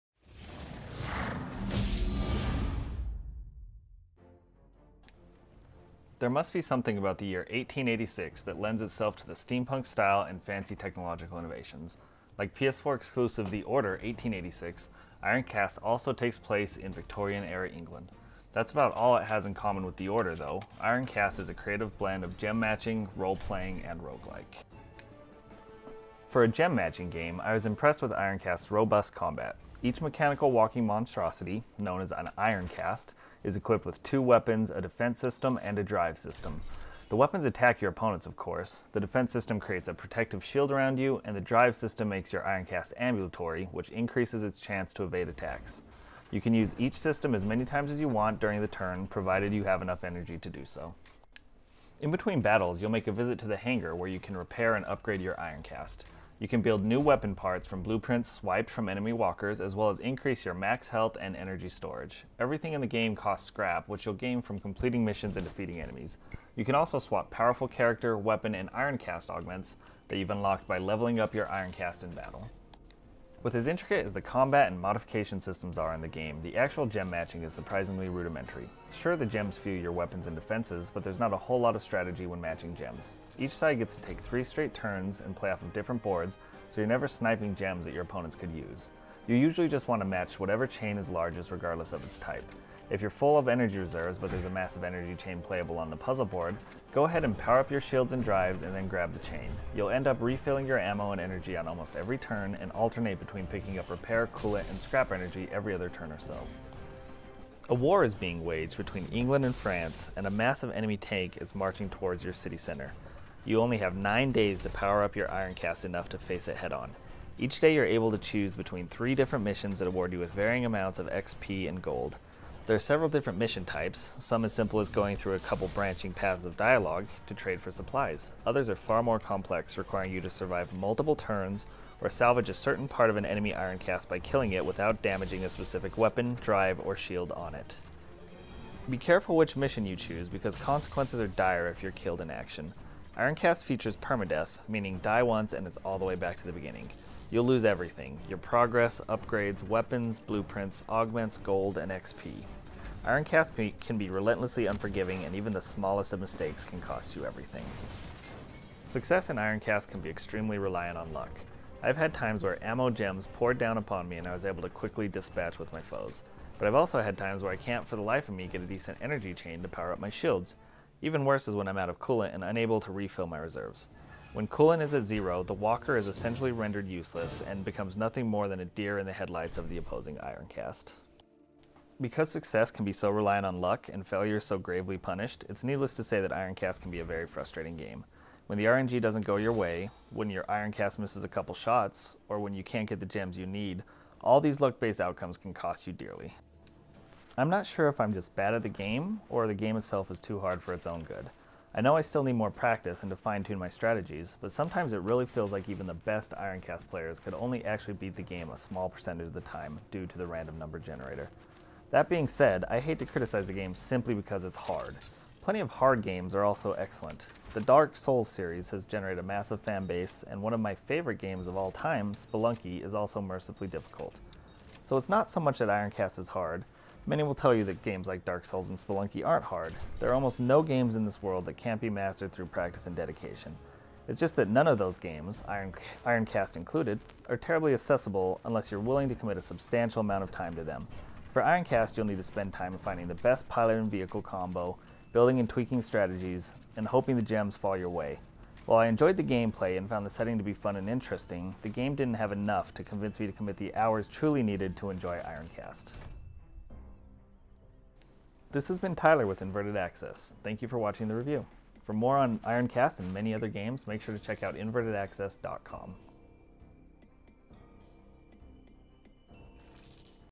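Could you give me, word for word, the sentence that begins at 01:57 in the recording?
Each day you're able to choose between 3 different missions that award you with varying amounts of XP and gold.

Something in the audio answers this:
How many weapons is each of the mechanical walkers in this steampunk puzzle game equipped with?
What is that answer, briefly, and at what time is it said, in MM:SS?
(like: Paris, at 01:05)
2, at 00:34.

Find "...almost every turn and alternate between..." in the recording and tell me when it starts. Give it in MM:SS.
01:41.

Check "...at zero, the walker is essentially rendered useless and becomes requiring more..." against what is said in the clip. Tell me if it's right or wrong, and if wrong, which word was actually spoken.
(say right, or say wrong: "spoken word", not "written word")
wrong: "nothing", not "requiring".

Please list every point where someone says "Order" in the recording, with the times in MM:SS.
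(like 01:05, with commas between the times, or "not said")
00:13, 00:20.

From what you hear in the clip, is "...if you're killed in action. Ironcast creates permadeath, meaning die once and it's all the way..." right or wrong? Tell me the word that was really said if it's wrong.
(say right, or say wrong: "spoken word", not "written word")
wrong: "features", not "creates".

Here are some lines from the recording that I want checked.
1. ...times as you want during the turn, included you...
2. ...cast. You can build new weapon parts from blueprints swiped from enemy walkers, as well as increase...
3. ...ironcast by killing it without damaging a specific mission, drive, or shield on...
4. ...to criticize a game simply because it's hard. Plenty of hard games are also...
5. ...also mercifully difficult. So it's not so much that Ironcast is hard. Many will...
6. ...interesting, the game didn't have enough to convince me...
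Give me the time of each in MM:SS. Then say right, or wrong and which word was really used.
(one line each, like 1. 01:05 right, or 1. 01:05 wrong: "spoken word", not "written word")
1. 00:47 wrong: "provided", not "included"
2. 00:55 right
3. 02:13 wrong: "weapon", not "mission"
4. 03:32 right
5. 03:42 right
6. 04:10 right.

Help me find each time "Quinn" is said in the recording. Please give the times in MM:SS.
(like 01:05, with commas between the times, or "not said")
not said.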